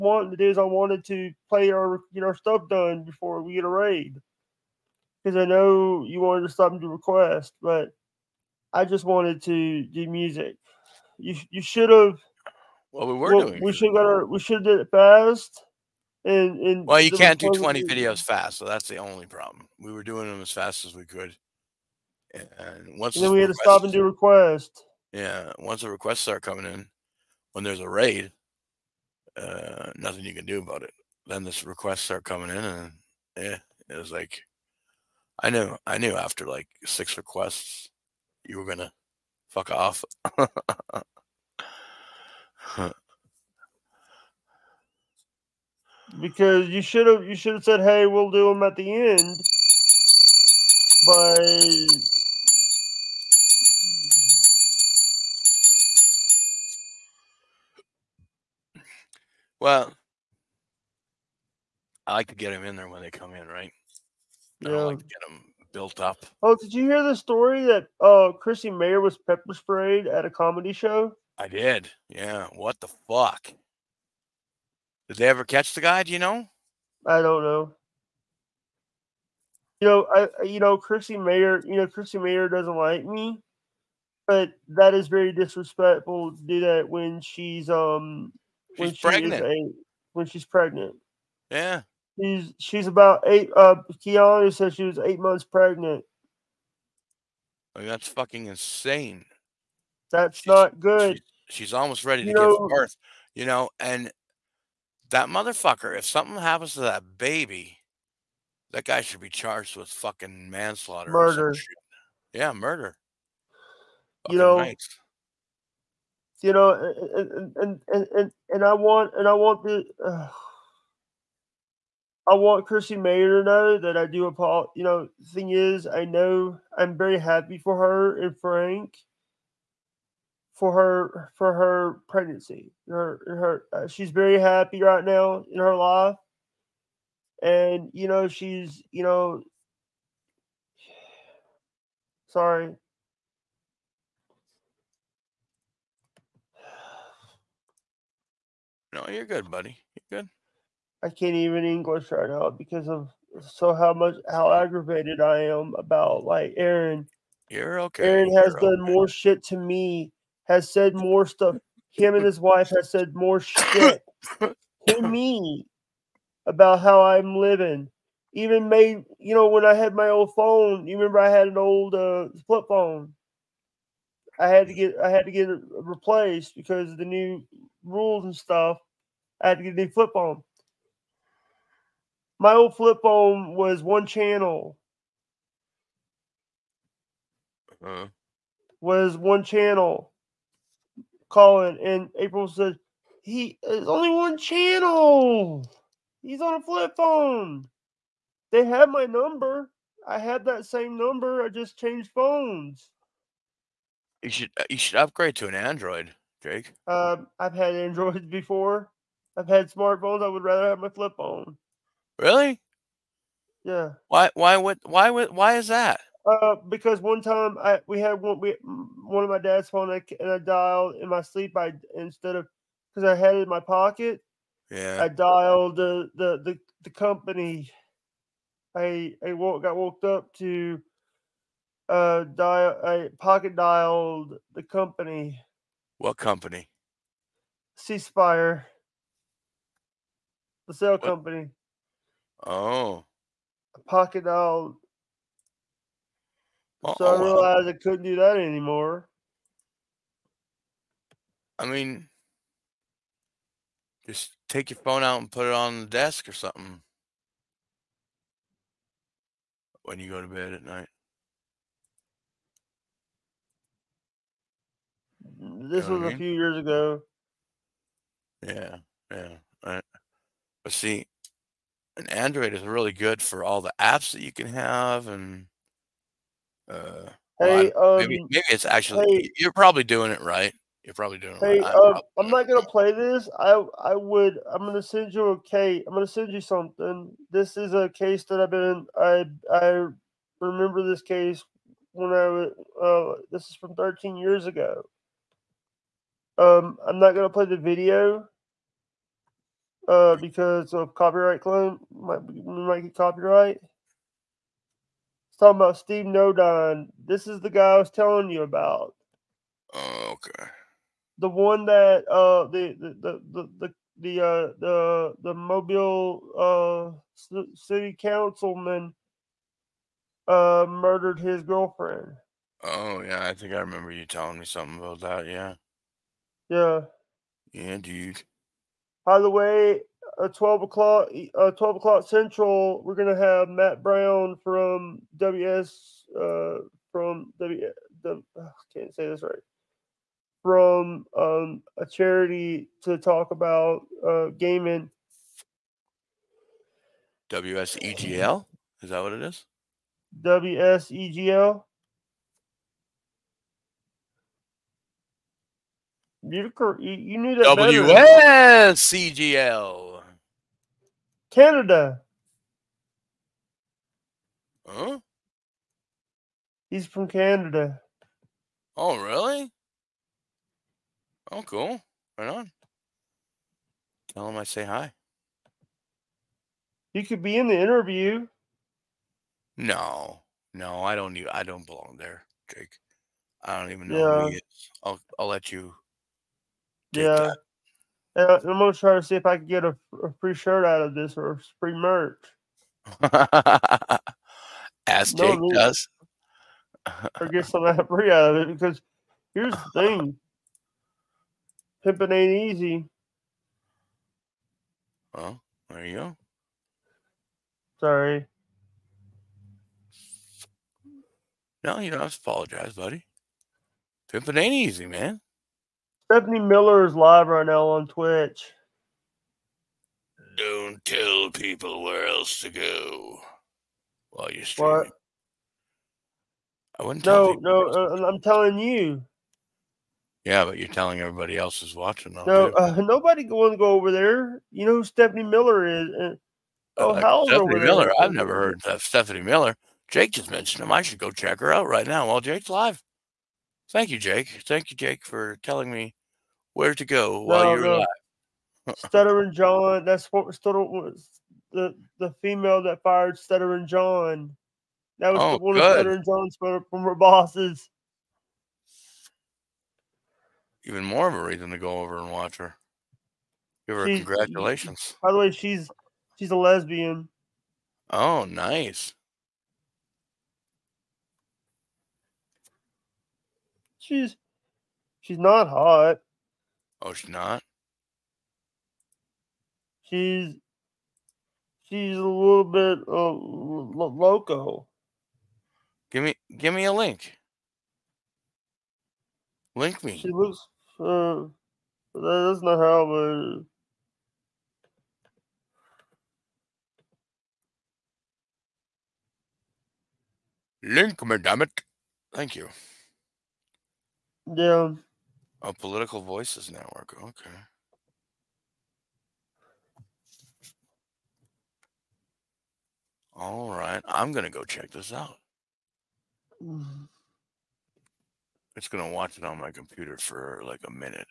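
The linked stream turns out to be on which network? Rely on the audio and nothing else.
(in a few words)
Political Voices Network.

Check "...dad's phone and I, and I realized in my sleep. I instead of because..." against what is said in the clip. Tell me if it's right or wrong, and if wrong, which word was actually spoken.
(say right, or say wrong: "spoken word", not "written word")
wrong: "dialed", not "realized".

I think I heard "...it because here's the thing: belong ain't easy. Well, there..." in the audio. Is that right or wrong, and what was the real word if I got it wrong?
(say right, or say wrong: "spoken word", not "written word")
wrong: "pimping", not "belong".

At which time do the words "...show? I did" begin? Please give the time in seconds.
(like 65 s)
70 s.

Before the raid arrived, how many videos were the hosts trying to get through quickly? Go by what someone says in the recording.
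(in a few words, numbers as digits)
20.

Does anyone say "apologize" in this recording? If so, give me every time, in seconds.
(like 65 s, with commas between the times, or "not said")
124 s, 412 s.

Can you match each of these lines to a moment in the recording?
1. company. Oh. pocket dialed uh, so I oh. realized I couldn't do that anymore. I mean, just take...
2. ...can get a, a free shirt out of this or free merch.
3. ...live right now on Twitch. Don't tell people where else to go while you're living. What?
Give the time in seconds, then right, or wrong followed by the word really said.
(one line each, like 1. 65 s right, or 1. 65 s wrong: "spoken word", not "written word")
1. 241 s right
2. 389 s right
3. 416 s wrong: "streaming", not "living".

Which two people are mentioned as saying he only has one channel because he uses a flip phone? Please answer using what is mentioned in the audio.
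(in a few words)
Colin and April.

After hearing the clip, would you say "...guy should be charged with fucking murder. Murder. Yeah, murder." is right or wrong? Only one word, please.
wrong.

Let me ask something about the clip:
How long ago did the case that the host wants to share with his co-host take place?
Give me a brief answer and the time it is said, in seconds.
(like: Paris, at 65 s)
13 years ago, at 293 s.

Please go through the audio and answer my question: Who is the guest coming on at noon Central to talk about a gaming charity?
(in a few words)
Matt Brown.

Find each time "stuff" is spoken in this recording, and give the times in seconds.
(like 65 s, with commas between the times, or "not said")
2 s, 161 s, 178 s.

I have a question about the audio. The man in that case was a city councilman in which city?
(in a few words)
Mobile.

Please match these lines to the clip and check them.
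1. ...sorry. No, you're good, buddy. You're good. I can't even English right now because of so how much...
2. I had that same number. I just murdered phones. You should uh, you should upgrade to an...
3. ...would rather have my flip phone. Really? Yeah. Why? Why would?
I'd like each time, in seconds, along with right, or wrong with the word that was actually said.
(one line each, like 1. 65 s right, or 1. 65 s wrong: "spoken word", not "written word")
1. 142 s right
2. 200 s wrong: "changed", not "murdered"
3. 210 s right.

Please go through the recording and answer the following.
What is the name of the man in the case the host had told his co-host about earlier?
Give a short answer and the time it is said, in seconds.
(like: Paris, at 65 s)
Steve Nodine, at 305 s.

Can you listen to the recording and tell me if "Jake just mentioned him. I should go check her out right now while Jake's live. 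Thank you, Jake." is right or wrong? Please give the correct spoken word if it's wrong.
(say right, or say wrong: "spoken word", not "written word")
right.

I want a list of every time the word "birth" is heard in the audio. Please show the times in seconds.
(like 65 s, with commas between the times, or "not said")
102 s.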